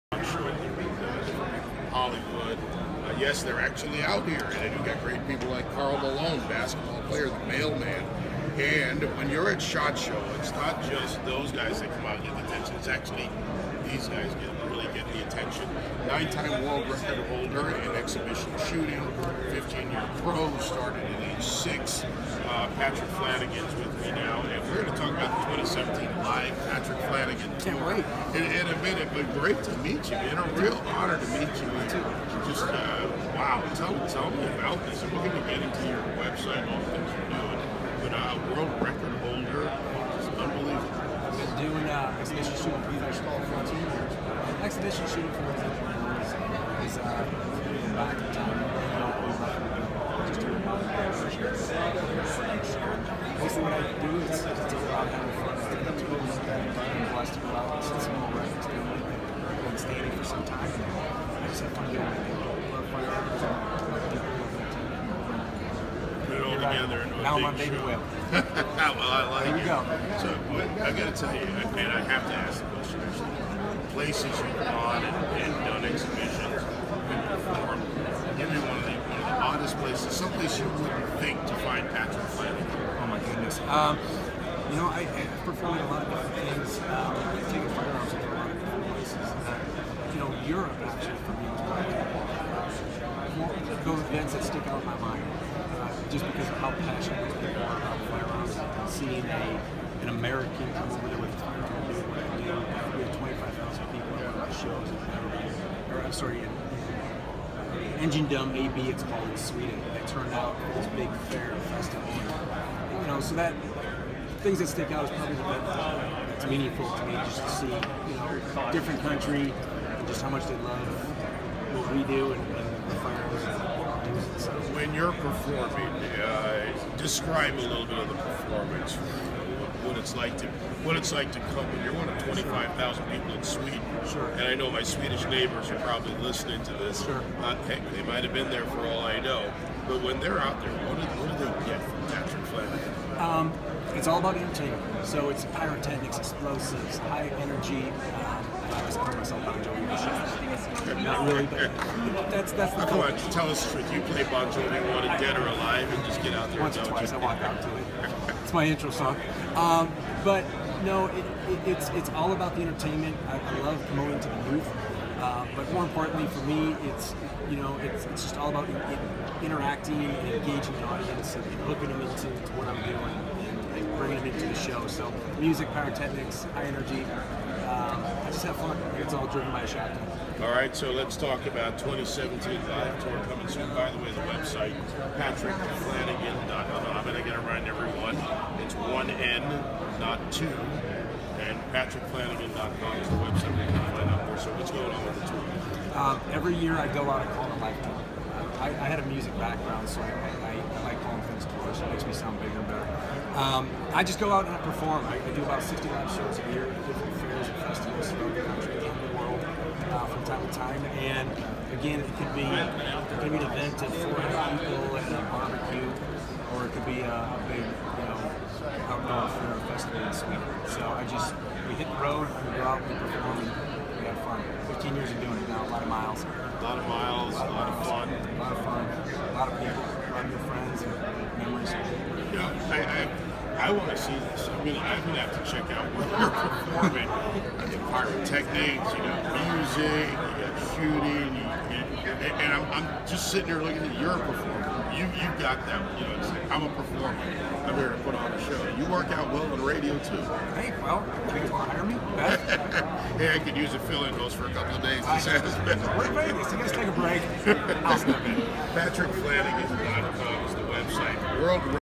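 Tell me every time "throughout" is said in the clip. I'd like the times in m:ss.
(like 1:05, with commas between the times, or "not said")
3:28.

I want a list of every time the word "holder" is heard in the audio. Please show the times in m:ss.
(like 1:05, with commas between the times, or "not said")
0:17, 0:39.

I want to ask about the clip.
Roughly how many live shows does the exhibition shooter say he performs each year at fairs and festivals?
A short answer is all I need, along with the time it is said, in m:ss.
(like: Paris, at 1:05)
60, at 3:25.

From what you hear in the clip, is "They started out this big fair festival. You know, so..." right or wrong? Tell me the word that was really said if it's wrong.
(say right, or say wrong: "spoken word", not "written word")
wrong: "turned", not "started".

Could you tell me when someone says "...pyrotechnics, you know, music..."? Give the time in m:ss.
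3:57.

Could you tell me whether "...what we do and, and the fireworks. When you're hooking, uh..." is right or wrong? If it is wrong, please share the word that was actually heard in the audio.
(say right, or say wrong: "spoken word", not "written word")
wrong: "performing", not "hooking".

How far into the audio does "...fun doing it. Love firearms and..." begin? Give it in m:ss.
1:01.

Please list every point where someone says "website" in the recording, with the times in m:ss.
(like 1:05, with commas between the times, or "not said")
0:36, 3:04, 3:13, 4:20.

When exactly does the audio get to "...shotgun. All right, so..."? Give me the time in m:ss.
2:59.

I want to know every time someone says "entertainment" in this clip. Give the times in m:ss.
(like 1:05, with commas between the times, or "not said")
2:24, 2:42.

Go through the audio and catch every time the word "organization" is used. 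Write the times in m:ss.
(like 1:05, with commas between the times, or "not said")
not said.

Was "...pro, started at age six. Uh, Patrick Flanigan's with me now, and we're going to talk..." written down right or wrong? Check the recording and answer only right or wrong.
right.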